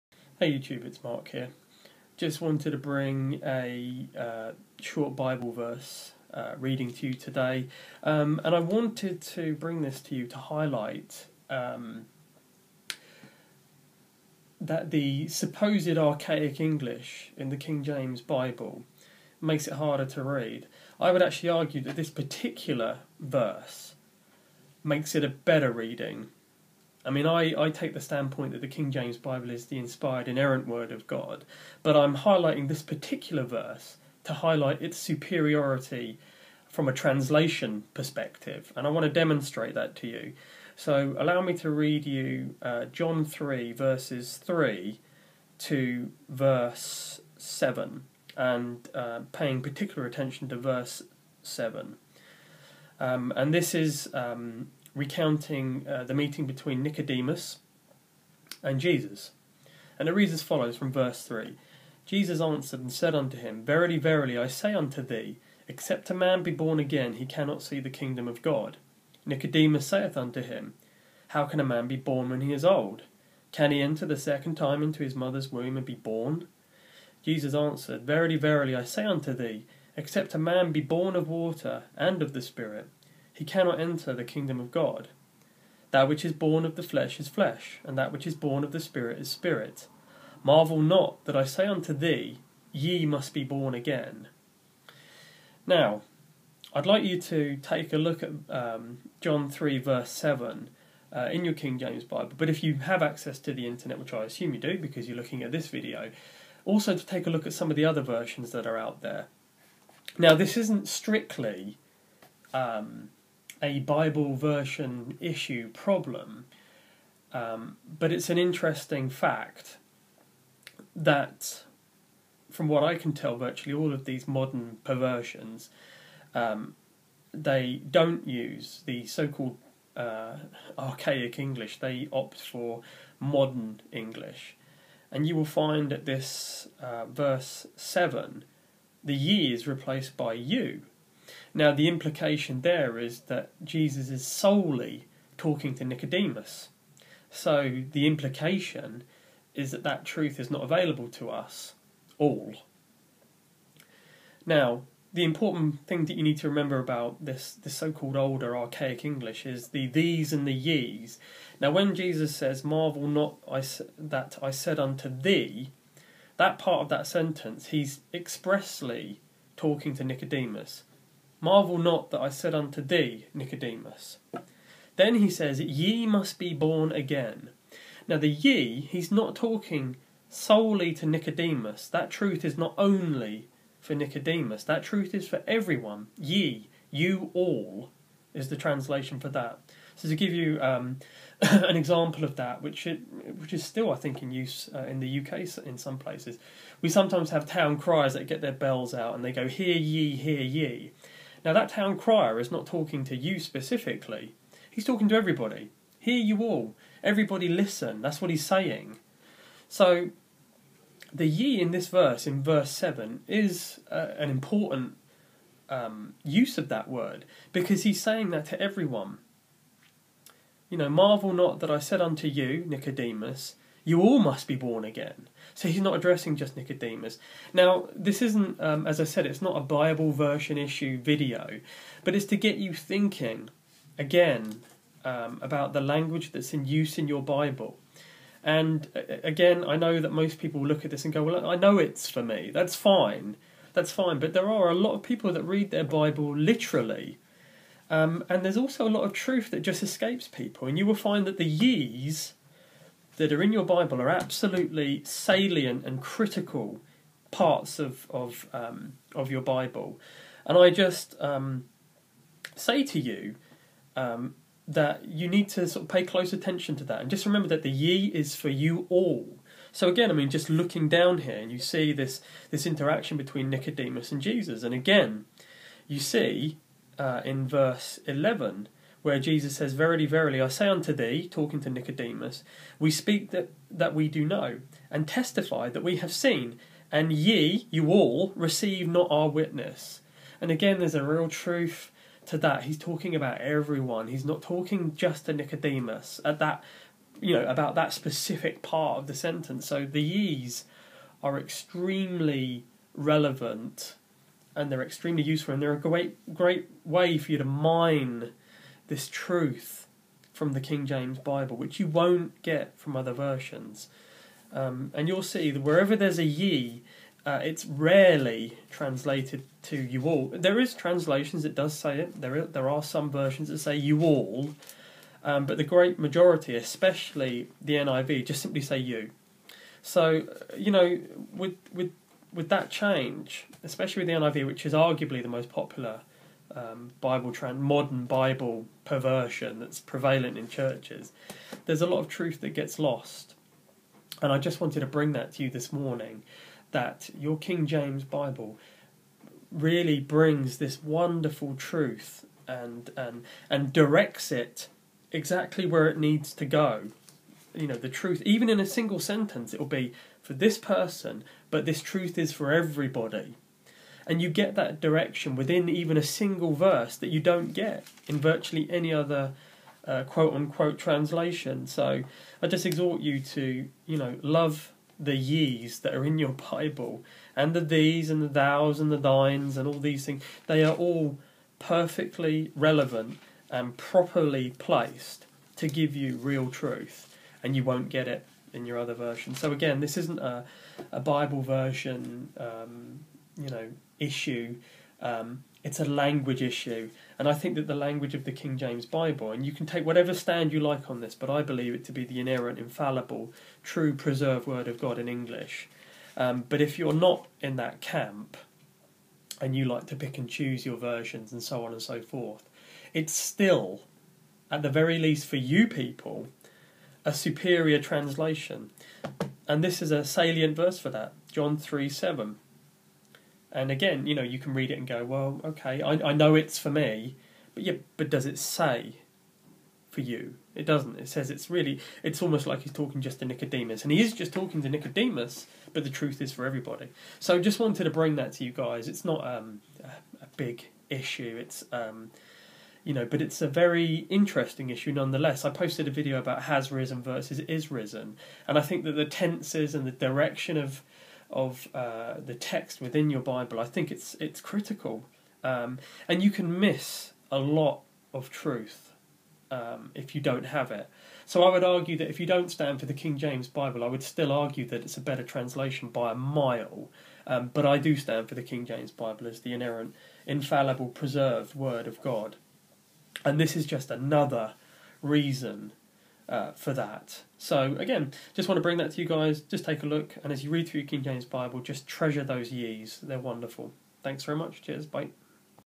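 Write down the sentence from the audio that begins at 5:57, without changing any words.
You know, the truth, even in a single sentence, it will be for this person, but this truth is for everybody.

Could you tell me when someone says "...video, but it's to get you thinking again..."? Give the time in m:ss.
3:50.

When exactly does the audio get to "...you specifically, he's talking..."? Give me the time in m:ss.
3:23.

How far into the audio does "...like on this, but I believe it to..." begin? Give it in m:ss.
6:40.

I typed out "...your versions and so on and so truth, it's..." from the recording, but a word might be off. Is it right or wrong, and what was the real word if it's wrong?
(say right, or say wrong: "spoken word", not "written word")
wrong: "forth", not "truth".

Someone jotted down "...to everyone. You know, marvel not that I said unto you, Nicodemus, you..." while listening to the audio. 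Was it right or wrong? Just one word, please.
right.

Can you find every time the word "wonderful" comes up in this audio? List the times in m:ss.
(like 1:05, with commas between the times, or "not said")
5:50, 8:03.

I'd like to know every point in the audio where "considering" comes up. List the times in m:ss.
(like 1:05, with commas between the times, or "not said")
not said.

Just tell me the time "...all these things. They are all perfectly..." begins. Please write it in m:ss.
6:19.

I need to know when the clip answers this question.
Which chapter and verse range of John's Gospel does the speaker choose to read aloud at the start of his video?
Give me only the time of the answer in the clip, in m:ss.
0:42.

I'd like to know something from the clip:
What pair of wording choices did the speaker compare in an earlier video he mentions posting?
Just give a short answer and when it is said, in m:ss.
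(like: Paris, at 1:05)
has risen versus is risen, at 7:26.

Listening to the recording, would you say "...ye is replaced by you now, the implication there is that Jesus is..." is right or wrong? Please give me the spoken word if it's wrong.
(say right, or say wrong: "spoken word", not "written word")
right.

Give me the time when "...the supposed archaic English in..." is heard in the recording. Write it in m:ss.
0:14.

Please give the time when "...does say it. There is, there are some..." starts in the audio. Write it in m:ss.
5:21.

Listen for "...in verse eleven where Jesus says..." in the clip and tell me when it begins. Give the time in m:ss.
4:37.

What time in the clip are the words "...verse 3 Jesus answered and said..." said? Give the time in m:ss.
1:00.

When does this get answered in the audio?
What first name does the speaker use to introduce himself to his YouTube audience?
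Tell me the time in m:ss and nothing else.
0:01.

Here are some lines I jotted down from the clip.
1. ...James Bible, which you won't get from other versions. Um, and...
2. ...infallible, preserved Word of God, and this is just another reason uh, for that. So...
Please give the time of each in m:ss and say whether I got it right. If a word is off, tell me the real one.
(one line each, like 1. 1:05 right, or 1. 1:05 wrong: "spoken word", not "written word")
1. 5:10 right
2. 7:50 right.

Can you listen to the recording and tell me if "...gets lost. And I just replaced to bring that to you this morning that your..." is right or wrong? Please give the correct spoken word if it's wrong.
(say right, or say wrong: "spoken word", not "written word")
wrong: "wanted", not "replaced".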